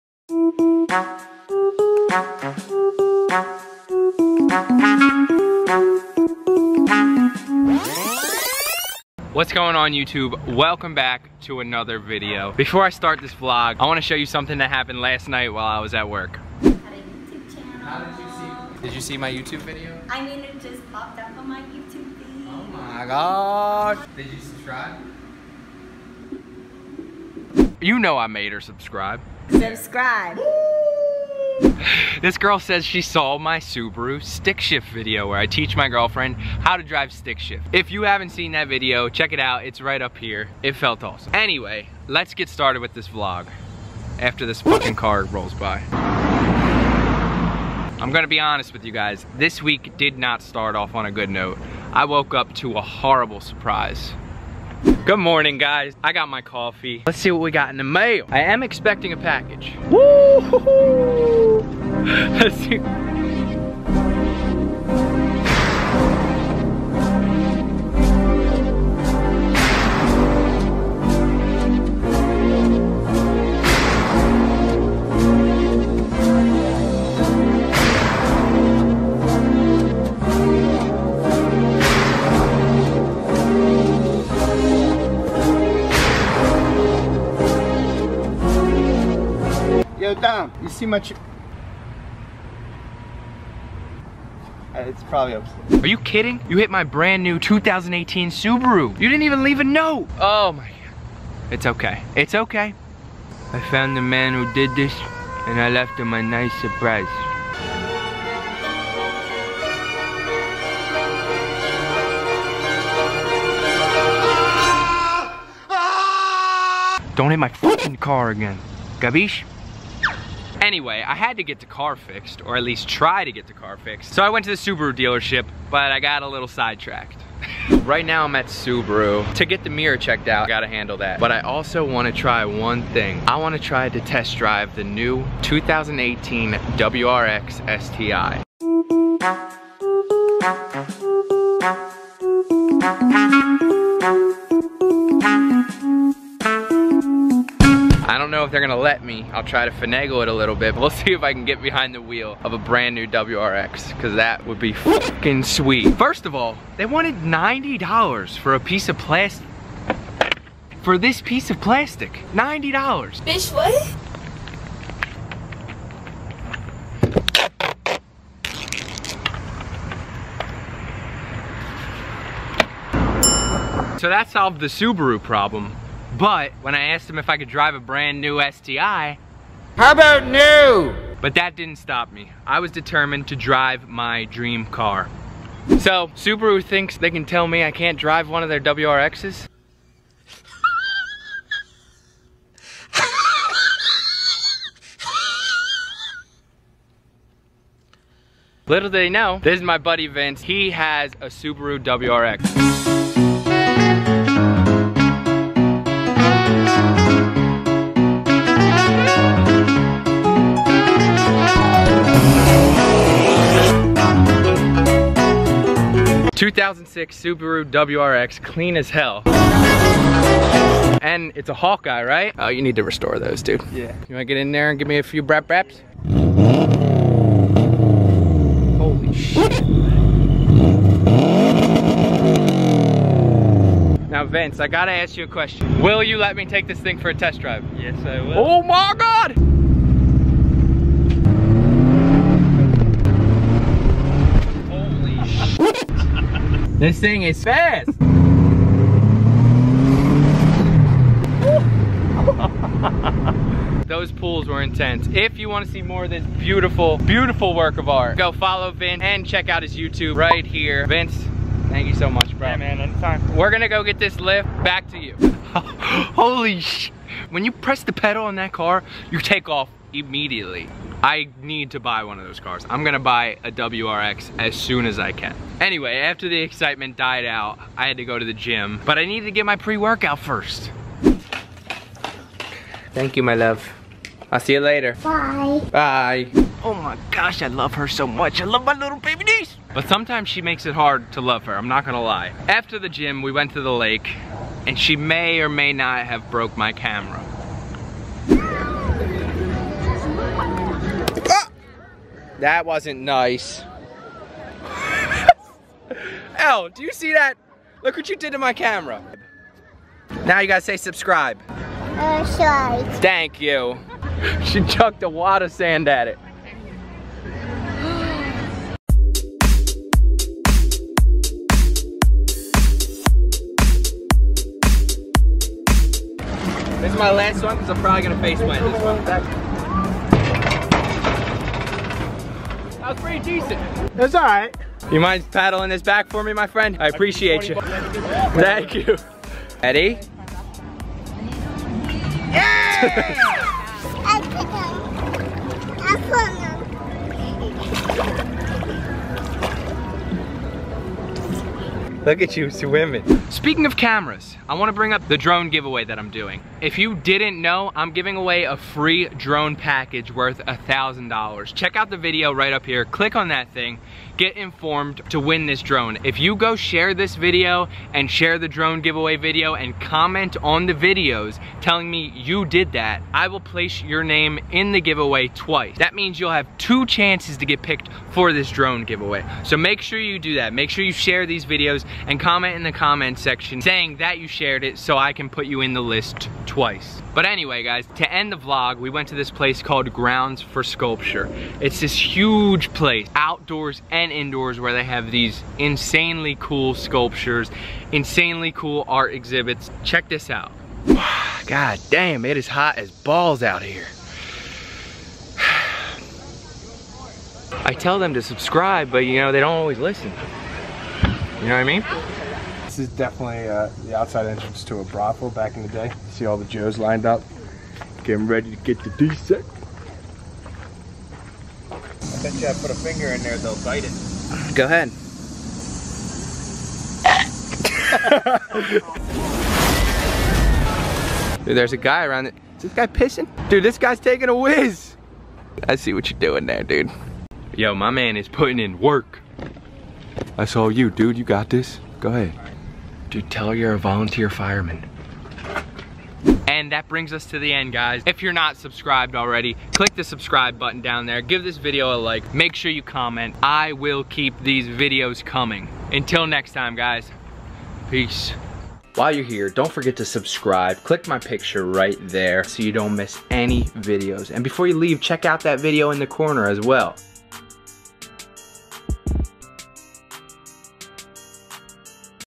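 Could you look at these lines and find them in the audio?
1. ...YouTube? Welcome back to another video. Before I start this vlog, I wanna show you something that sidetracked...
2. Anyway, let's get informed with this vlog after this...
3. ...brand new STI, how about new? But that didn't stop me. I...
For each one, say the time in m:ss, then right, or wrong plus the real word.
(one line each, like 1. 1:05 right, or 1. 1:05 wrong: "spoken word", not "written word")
1. 0:09 wrong: "happened", not "sidetracked"
2. 0:41 wrong: "started", not "informed"
3. 2:57 right.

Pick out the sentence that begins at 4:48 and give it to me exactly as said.
I love my little baby niece.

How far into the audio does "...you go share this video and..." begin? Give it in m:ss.
6:06.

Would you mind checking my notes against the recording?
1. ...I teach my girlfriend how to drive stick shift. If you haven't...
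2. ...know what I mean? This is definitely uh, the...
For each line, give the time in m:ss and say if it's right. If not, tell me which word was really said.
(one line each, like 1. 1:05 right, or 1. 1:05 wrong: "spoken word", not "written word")
1. 0:35 right
2. 6:51 right.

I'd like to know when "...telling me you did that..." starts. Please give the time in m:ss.
6:11.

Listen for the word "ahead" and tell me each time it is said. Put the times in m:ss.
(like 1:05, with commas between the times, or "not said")
7:04, 7:22.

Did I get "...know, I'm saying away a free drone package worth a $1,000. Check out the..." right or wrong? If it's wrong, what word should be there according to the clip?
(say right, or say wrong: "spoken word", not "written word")
wrong: "giving", not "saying".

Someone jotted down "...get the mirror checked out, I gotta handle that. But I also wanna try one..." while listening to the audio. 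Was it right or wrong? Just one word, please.
right.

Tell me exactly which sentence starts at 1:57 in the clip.
Don't hit my fucking car again.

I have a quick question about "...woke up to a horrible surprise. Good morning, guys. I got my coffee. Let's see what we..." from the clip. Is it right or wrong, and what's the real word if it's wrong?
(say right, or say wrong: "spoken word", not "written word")
right.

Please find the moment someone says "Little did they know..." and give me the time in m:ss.
3:18.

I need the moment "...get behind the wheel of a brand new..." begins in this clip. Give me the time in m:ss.
2:31.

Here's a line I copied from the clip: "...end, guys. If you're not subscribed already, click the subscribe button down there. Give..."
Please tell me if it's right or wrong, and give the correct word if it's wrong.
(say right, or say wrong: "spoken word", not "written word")
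right.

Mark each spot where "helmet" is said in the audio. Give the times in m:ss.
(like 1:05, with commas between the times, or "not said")
not said.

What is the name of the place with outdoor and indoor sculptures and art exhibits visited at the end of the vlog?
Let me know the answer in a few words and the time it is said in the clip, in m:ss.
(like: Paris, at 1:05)
Grounds for Sculpture, at 6:29.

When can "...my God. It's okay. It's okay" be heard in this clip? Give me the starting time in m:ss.
1:40.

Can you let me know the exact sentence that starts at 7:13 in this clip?
Dude, this guy's taking a whiz.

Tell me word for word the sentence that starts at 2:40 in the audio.
For this piece of plastic, $90.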